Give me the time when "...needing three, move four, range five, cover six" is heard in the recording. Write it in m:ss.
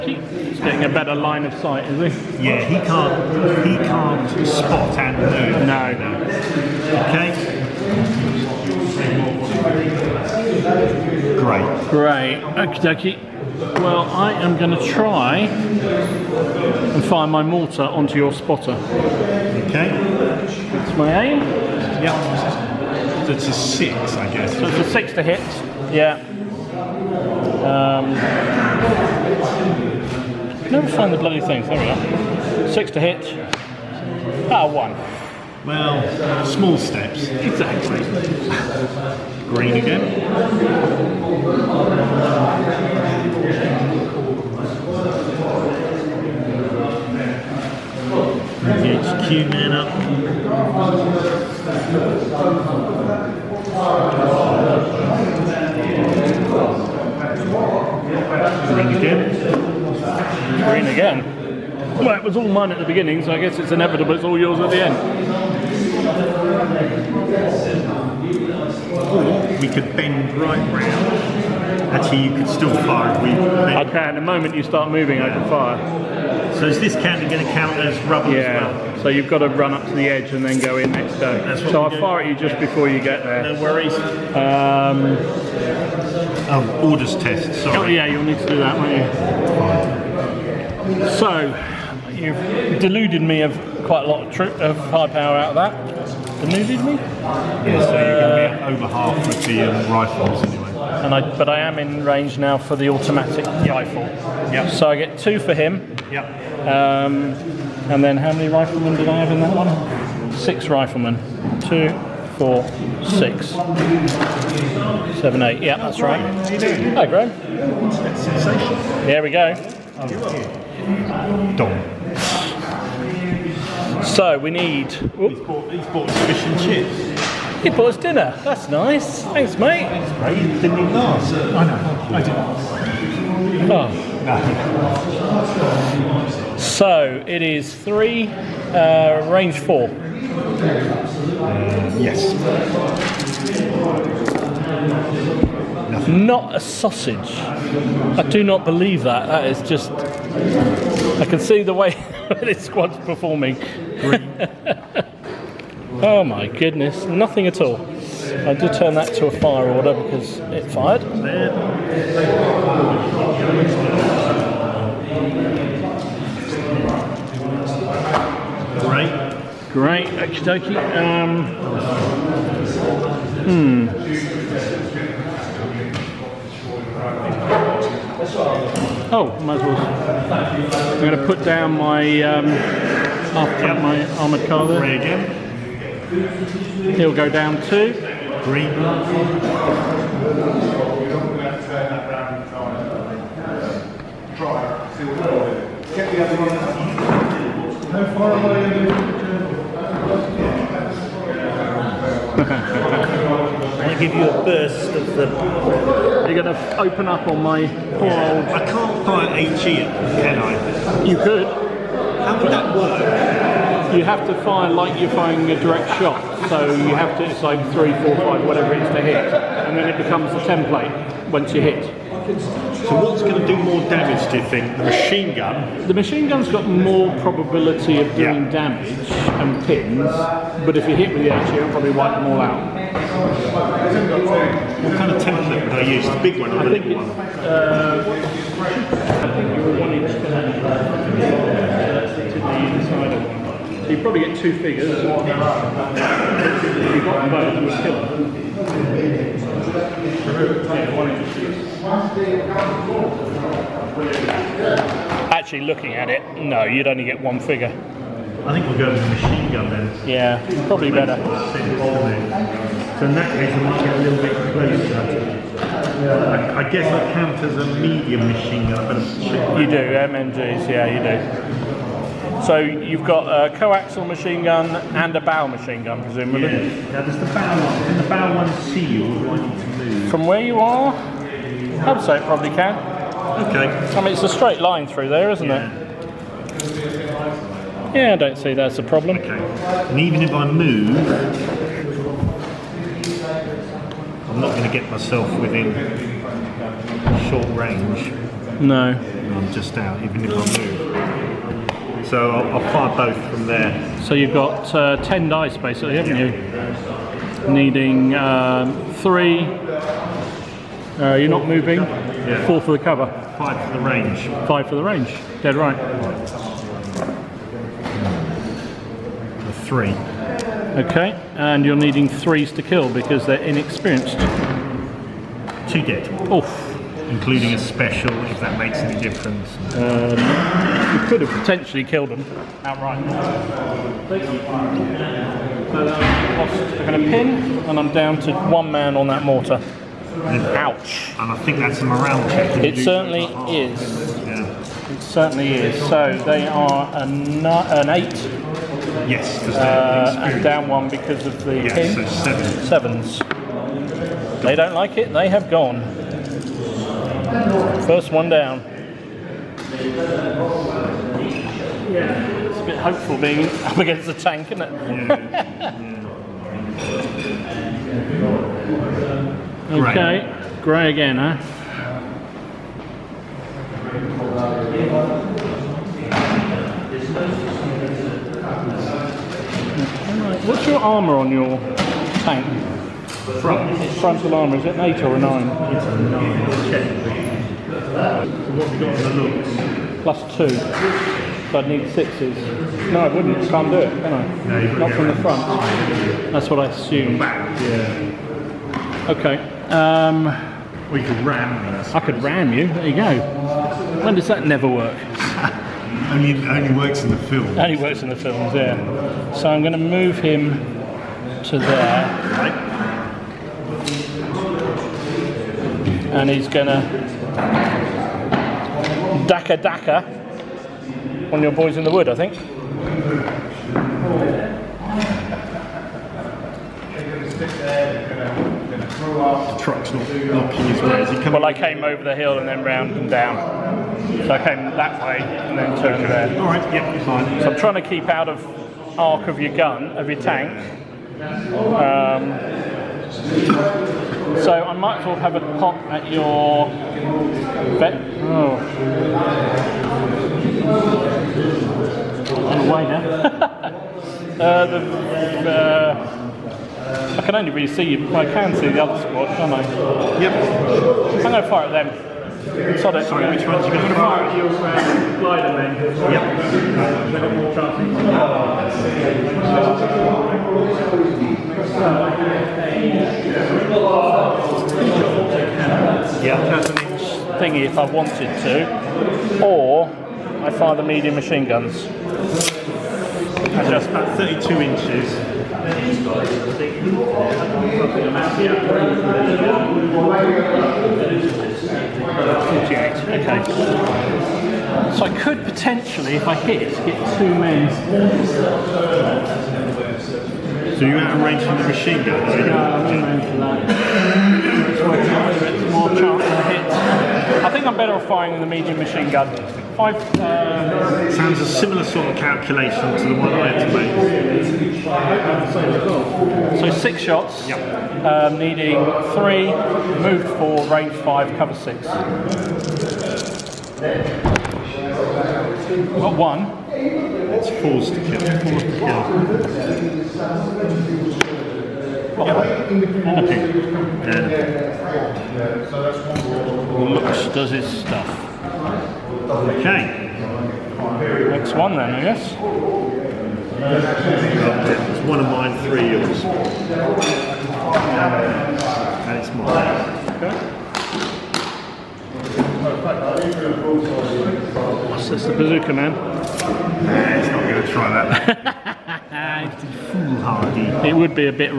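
8:38.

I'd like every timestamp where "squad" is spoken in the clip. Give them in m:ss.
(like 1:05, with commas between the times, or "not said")
2:32, 7:39.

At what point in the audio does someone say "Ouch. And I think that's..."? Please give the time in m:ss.
5:40.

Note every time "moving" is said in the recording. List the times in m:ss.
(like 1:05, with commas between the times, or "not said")
1:14, 5:11.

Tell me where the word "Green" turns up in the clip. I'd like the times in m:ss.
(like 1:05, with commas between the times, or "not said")
0:39, 0:51, 1:00, 3:08.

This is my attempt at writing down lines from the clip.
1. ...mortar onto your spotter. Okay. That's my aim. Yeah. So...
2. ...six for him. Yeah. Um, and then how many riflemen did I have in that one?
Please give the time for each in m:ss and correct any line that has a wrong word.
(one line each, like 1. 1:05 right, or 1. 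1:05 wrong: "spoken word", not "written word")
1. 0:17 right
2. 1:45 wrong: "two", not "six".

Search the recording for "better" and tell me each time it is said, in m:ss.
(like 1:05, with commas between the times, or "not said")
0:00, 4:20, 8:27.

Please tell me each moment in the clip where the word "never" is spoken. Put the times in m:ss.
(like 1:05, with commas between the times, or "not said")
0:30, 6:44.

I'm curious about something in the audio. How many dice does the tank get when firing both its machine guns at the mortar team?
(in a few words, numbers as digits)
10.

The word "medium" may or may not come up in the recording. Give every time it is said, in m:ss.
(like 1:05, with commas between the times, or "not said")
4:27, 8:00, 8:28.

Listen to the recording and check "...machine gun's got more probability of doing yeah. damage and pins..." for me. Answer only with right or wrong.
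right.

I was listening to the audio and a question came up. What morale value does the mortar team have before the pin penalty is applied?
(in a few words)
8.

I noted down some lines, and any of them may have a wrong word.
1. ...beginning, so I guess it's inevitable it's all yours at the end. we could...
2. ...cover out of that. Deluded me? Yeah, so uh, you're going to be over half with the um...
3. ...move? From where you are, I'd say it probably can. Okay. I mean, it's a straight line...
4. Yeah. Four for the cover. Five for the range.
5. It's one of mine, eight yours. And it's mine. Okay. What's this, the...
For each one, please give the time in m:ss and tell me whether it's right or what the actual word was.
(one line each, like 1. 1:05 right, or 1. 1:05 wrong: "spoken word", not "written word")
1. 1:02 right
2. 1:35 wrong: "power", not "cover"
3. 4:39 right
4. 5:11 right
5. 9:05 wrong: "three", not "eight".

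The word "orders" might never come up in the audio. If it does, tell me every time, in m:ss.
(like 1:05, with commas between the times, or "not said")
1:26, 2:39.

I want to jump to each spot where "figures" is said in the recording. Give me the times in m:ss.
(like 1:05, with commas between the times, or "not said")
4:04, 4:17.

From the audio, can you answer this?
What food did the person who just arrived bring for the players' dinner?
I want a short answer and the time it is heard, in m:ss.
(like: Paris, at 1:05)
fish and chips, at 2:06.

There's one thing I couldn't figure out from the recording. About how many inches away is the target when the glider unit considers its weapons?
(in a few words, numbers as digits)
32.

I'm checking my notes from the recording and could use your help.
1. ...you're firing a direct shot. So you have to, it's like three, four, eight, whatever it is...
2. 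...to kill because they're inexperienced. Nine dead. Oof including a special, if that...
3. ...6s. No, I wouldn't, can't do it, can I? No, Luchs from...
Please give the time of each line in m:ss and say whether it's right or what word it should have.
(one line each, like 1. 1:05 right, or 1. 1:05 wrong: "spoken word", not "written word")
1. 3:34 wrong: "five", not "eight"
2. 5:22 wrong: "Two", not "Nine"
3. 6:31 wrong: "Not", not "Luchs".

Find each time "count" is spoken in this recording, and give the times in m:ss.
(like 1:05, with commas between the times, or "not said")
1:17, 4:27.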